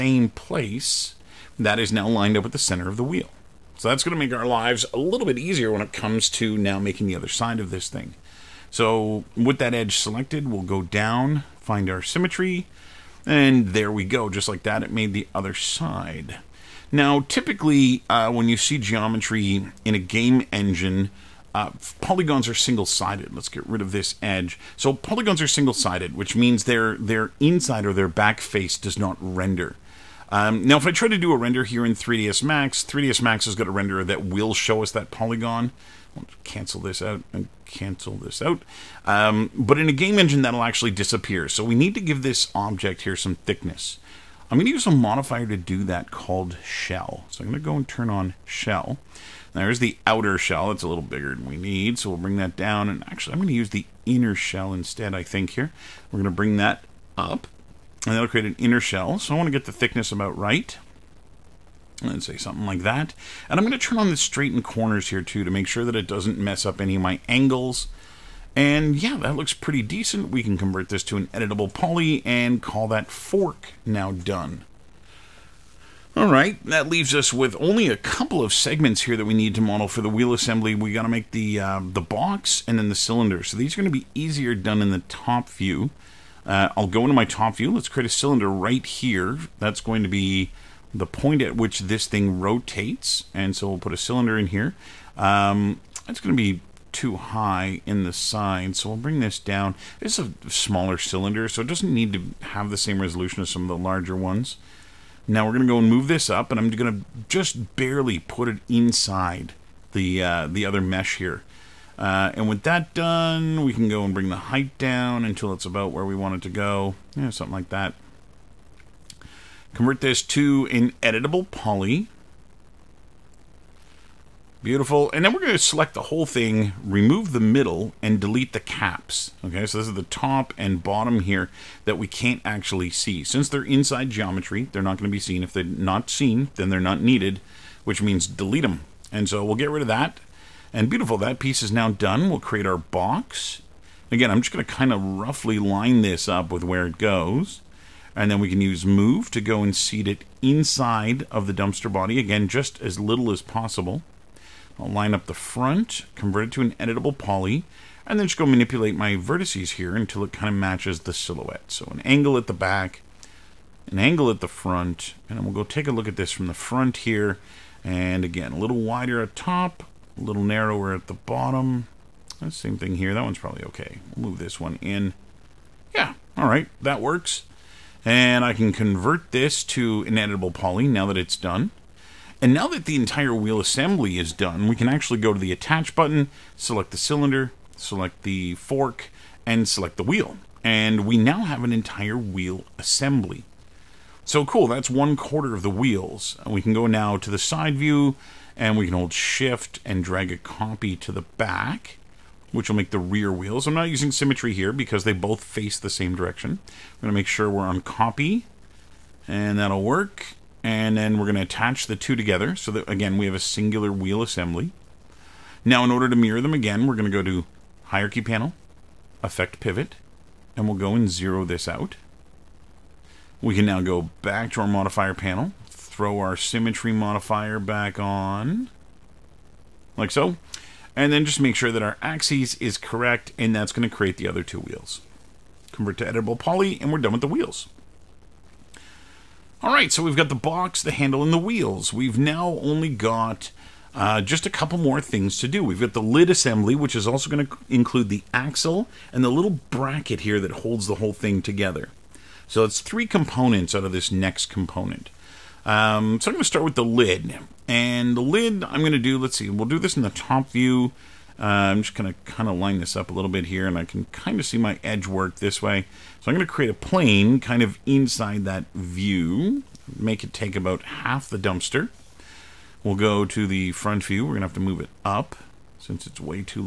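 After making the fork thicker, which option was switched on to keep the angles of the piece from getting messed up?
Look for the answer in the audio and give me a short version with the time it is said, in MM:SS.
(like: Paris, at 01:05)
straighten corners, at 01:04.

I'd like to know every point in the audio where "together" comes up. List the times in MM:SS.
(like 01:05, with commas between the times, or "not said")
03:32, 04:11.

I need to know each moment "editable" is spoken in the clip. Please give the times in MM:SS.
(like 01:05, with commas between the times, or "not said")
01:11, 02:01, 02:36, 03:00, 03:56.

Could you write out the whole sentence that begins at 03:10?
And we now have an entire wheel assembly.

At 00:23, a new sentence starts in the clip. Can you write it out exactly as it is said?
Let's get rid of this edge.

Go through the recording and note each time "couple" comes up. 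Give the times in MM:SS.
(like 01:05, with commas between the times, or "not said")
01:17, 04:04.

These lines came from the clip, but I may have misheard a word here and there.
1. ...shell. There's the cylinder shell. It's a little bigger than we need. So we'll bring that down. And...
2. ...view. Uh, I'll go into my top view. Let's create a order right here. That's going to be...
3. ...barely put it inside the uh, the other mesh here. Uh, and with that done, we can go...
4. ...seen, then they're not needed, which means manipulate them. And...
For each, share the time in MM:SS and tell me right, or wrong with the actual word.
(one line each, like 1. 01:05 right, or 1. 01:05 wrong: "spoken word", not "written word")
1. 00:48 wrong: "outer", not "cylinder"
2. 01:25 wrong: "cylinder", not "order"
3. 01:47 right
4. 02:16 wrong: "delete", not "manipulate".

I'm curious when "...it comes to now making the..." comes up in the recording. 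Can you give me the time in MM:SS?
00:05.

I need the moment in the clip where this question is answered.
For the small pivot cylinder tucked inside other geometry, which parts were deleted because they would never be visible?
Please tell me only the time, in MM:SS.
02:08.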